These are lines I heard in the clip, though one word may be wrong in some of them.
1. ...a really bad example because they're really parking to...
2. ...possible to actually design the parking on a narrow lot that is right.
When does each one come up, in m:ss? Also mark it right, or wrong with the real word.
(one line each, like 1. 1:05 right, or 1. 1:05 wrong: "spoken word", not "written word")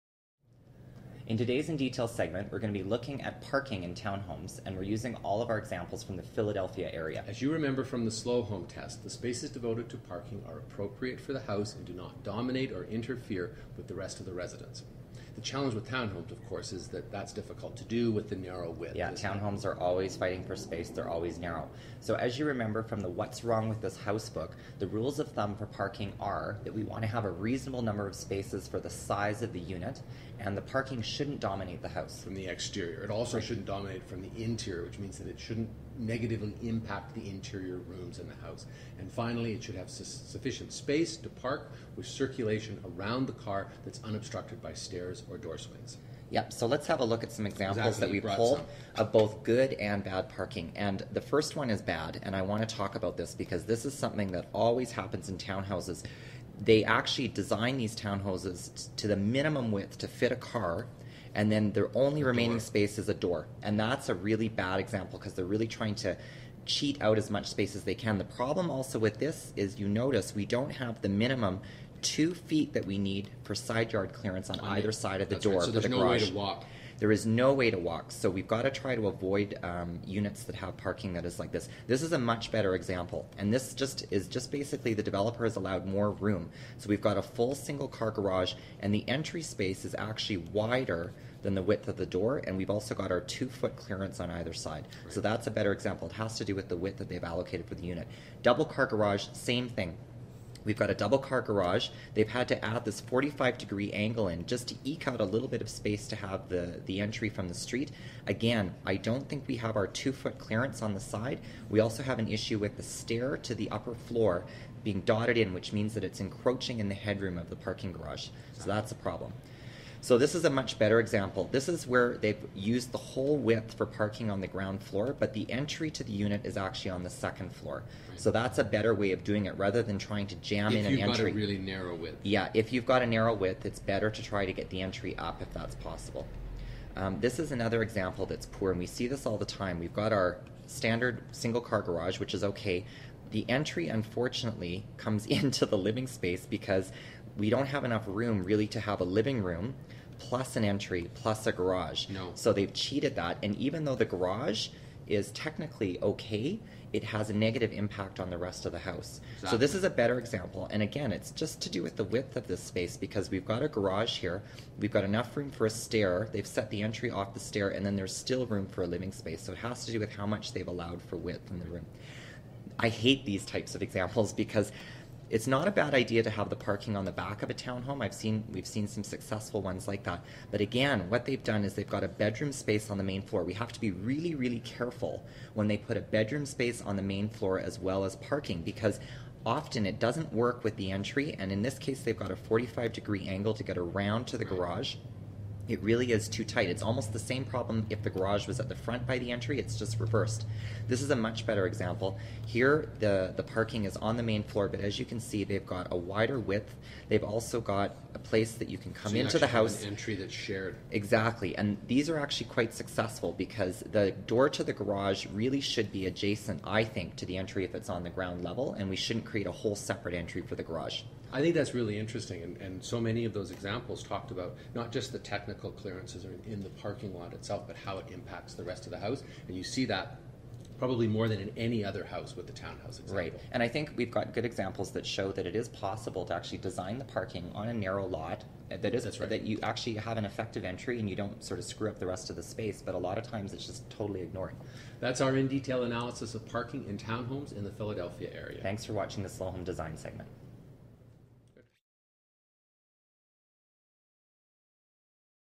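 1. 1:04 wrong: "trying", not "parking"
2. 3:55 right.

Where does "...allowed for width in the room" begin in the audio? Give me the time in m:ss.
2:50.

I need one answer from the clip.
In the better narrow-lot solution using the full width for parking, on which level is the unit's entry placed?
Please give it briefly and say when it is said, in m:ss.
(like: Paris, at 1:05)
Second floor, at 2:07.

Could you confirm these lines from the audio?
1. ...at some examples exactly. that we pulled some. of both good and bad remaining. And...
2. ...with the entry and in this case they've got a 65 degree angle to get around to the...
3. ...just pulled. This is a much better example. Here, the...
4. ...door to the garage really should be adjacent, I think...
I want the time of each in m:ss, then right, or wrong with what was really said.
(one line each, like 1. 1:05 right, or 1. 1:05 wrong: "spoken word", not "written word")
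1. 0:47 wrong: "parking", not "remaining"
2. 3:10 wrong: "45", not "65"
3. 3:19 wrong: "reversed", not "pulled"
4. 3:34 right.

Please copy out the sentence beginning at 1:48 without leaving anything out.
Again, I don't think we have our two foot clearance on the side.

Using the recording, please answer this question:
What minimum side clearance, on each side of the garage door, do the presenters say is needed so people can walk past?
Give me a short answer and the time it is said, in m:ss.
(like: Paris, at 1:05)
2 feet, at 1:12.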